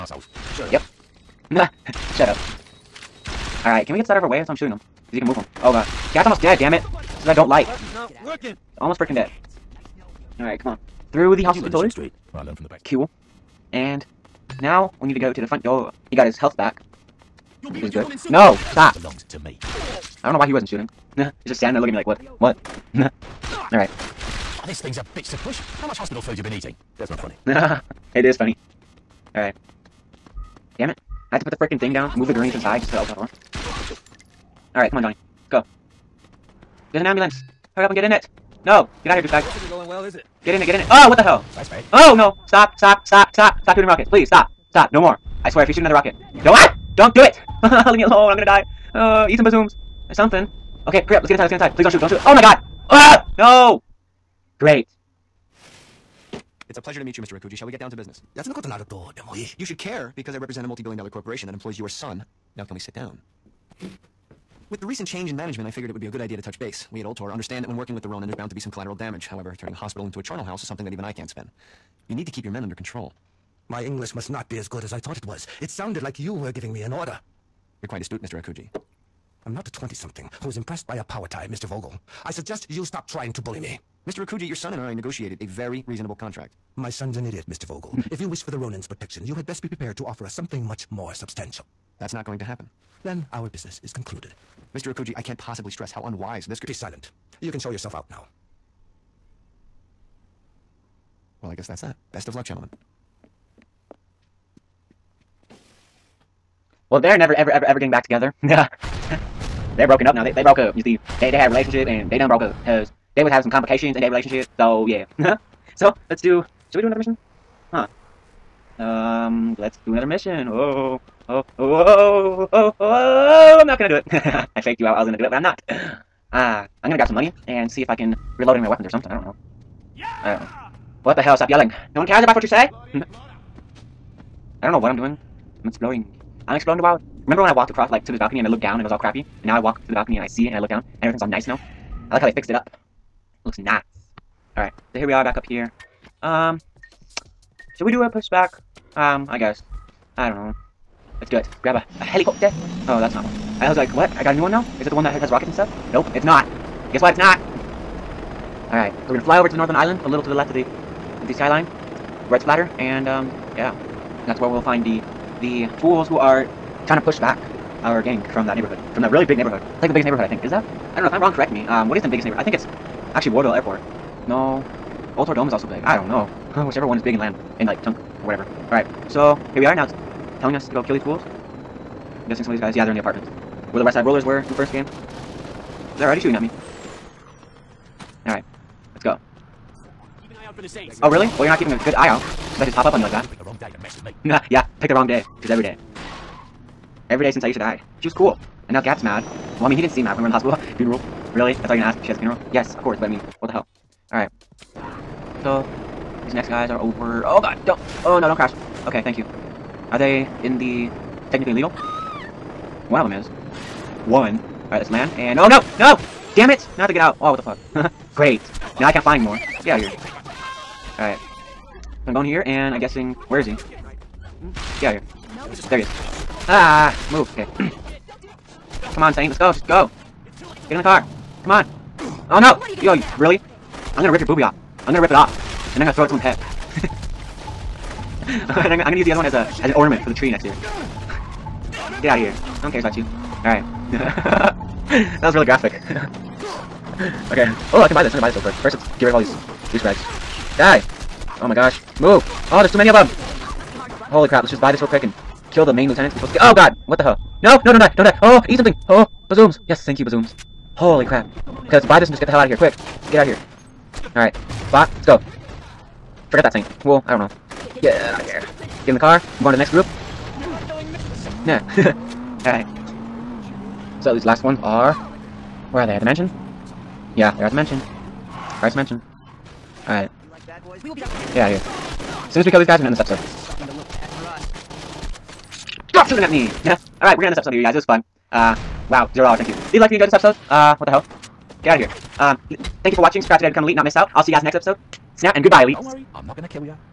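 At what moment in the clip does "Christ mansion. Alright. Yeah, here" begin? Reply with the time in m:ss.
4:38.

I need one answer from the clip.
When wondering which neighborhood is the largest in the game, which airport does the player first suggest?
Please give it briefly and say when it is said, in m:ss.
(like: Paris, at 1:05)
Wardill Airport, at 2:53.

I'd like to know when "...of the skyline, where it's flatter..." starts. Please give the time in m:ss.
2:40.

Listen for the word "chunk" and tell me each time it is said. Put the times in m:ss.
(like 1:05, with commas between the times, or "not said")
2:57.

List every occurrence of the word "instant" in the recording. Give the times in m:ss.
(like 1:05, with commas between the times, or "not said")
not said.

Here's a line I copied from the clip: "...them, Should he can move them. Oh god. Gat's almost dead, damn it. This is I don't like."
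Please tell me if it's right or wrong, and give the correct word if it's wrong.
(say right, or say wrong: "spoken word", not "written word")
wrong: "Because", not "Should".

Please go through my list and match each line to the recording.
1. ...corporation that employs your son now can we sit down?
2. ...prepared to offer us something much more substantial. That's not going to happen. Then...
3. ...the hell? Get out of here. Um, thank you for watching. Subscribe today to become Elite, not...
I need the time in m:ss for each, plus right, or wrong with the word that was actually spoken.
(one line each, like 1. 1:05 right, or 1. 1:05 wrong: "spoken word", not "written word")
1. 1:01 right
2. 1:29 right
3. 4:50 right.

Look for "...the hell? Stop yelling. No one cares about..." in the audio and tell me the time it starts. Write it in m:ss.
2:11.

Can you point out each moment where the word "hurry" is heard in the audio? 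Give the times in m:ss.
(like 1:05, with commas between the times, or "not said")
0:37, 0:51.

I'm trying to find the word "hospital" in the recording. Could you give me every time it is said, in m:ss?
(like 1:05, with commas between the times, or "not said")
0:11, 0:25, 1:09, 3:20.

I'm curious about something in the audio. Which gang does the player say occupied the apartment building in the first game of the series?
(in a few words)
West Side Rollers.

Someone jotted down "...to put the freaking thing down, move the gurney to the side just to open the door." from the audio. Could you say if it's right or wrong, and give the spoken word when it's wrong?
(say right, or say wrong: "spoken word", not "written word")
right.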